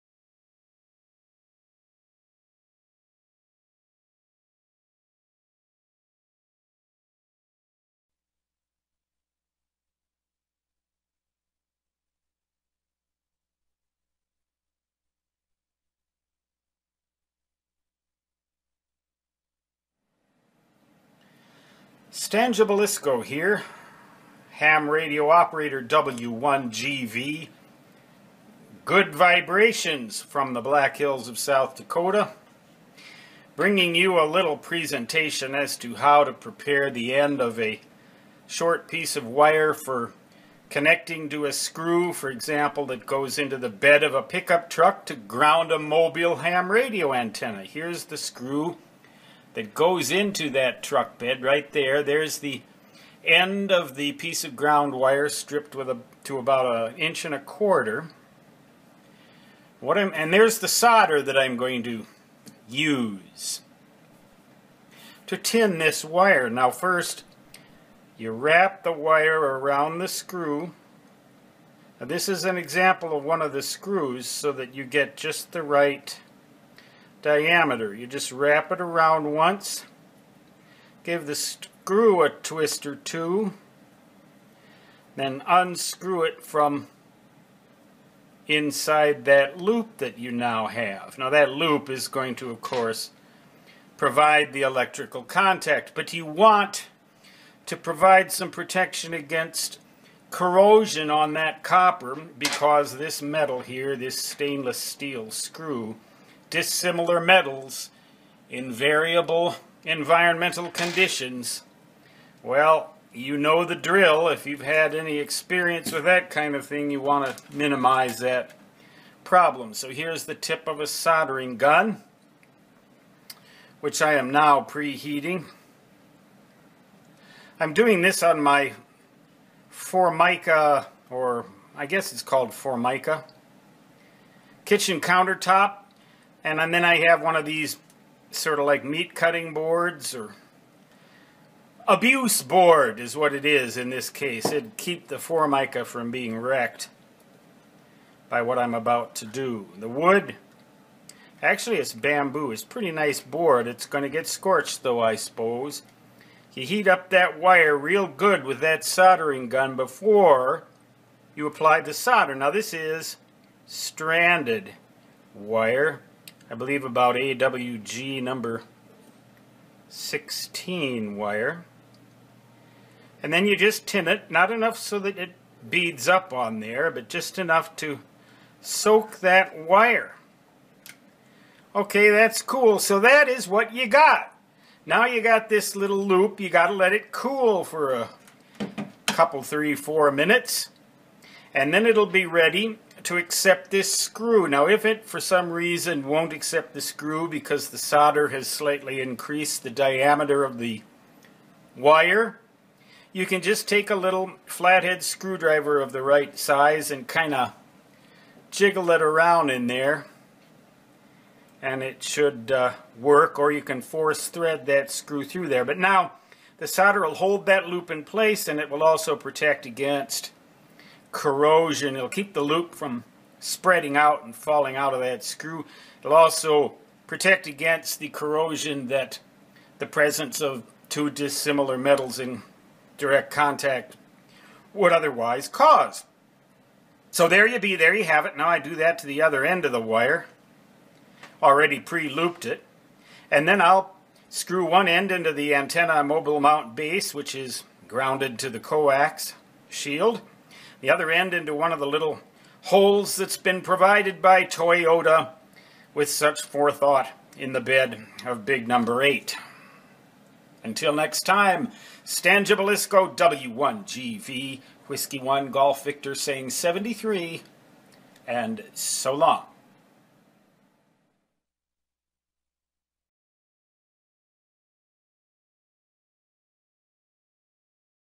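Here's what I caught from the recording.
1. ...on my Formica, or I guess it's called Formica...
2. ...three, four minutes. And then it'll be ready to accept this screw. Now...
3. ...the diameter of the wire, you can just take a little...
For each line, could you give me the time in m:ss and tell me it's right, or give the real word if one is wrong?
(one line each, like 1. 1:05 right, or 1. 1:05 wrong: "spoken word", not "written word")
1. 2:08 right
2. 3:09 right
3. 3:19 right.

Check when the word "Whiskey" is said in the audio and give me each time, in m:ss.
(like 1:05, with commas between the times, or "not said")
4:24.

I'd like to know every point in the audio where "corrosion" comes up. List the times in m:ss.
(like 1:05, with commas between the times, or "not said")
1:40, 3:41, 3:48.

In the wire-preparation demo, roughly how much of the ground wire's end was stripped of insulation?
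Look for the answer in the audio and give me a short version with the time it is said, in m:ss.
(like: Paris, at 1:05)
1 1/4 inches, at 0:56.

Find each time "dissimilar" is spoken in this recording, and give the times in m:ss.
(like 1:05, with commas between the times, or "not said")
1:46, 3:51.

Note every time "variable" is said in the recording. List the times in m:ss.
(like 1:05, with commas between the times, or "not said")
1:48.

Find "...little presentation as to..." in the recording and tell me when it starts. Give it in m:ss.
0:34.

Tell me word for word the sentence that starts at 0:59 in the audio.
What I'm, and there's the solder that I'm going to use to tin this wire.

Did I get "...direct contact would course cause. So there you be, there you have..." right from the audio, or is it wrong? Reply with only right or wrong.
wrong.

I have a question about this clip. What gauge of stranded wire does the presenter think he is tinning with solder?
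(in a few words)
AWG 16.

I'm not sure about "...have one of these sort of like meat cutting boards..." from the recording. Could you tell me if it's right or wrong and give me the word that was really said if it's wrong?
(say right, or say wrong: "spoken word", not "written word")
right.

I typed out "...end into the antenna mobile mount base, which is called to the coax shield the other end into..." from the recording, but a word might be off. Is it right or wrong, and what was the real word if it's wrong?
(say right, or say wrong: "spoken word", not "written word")
wrong: "grounded", not "called".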